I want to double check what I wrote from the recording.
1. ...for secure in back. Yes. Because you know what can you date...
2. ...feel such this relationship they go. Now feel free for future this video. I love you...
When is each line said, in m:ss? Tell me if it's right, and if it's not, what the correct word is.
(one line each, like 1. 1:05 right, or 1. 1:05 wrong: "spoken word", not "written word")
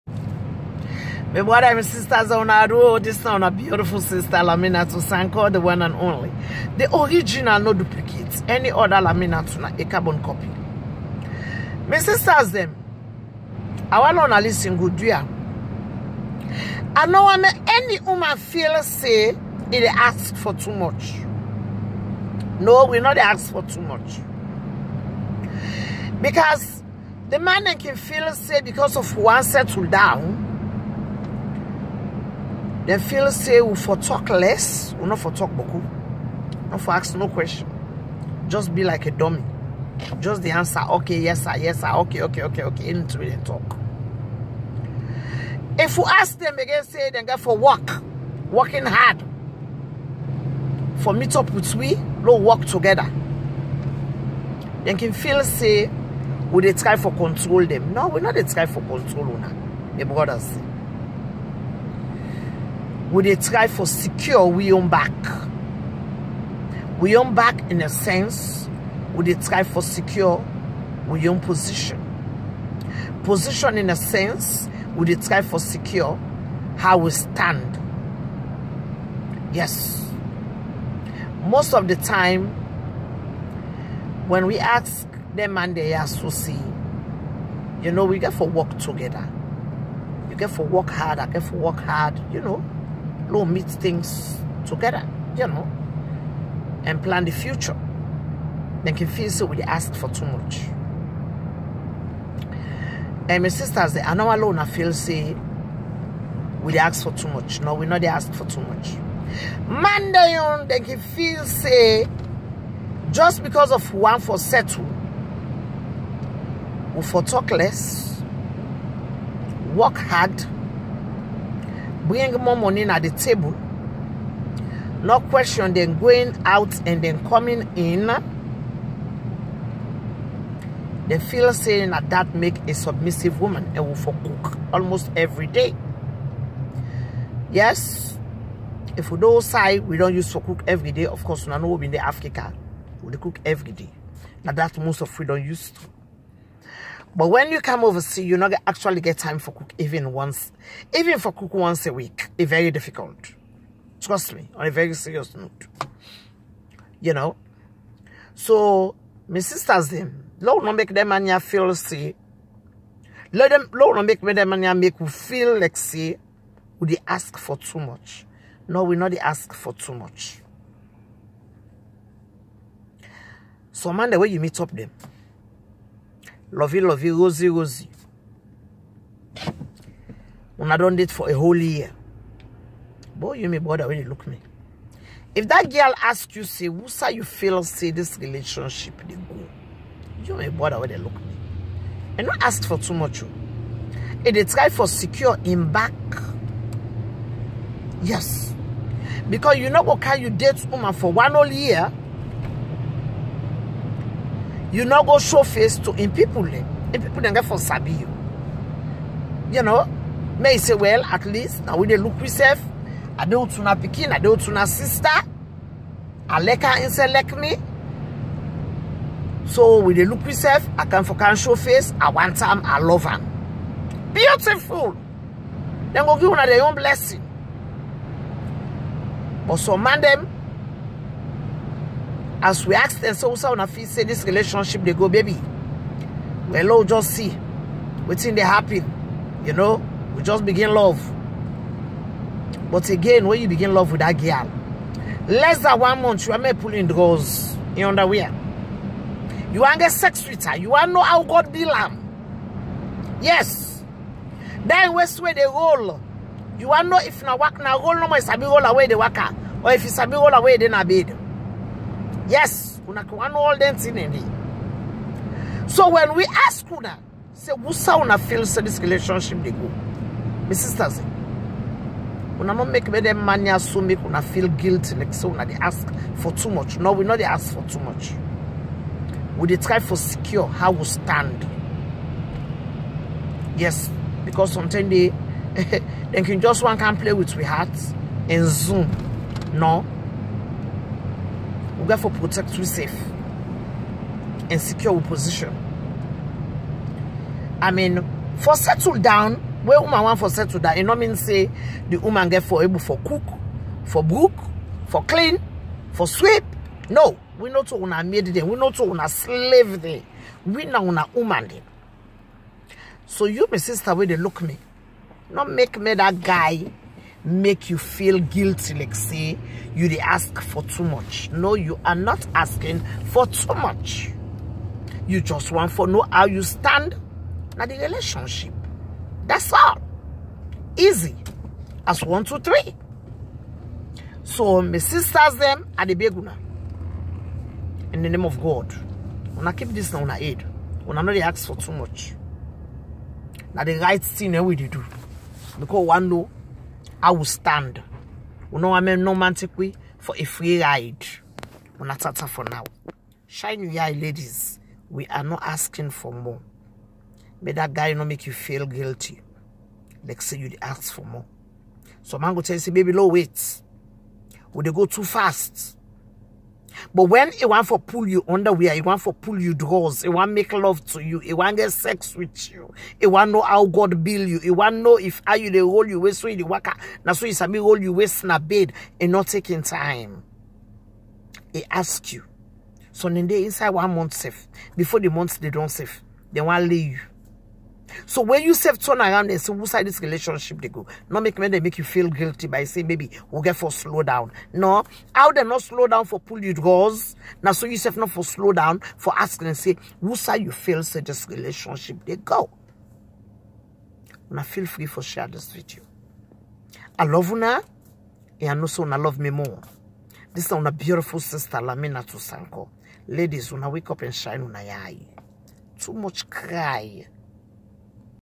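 1. 3:14 right
2. 6:40 wrong: "share", not "future".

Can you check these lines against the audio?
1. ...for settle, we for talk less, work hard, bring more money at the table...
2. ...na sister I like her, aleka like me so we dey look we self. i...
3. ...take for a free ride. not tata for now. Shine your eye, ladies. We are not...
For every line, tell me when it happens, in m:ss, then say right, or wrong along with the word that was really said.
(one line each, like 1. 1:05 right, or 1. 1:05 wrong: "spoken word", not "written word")
1. 1:54 right
2. 3:34 right
3. 5:49 right.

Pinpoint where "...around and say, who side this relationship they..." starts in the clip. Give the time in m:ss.
6:29.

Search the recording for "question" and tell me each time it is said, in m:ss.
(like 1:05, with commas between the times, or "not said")
0:37, 2:05.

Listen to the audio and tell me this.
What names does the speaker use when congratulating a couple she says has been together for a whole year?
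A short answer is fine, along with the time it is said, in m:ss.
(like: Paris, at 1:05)
Lovey Lovey Rosie Rosie, at 2:56.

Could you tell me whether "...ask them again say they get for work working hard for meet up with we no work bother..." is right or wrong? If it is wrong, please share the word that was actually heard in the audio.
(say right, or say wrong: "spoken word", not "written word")
wrong: "together", not "bother".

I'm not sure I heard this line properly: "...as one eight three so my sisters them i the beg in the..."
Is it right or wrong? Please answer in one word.
wrong.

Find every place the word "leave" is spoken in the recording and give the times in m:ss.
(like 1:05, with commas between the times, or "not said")
6:26.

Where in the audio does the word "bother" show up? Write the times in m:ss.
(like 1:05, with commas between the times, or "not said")
3:03, 3:10.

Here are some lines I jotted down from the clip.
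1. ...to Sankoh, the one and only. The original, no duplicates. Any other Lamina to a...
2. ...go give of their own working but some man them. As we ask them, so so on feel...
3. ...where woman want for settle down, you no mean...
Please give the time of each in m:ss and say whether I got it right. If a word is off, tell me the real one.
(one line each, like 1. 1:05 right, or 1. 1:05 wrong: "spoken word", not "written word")
1. 0:04 right
2. 3:46 wrong: "blessing", not "working"
3. 4:59 right.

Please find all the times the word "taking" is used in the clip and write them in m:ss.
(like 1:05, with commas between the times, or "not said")
6:19.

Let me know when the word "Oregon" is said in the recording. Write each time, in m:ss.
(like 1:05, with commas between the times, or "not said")
not said.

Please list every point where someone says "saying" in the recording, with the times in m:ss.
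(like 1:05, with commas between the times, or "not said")
2:11, 6:32.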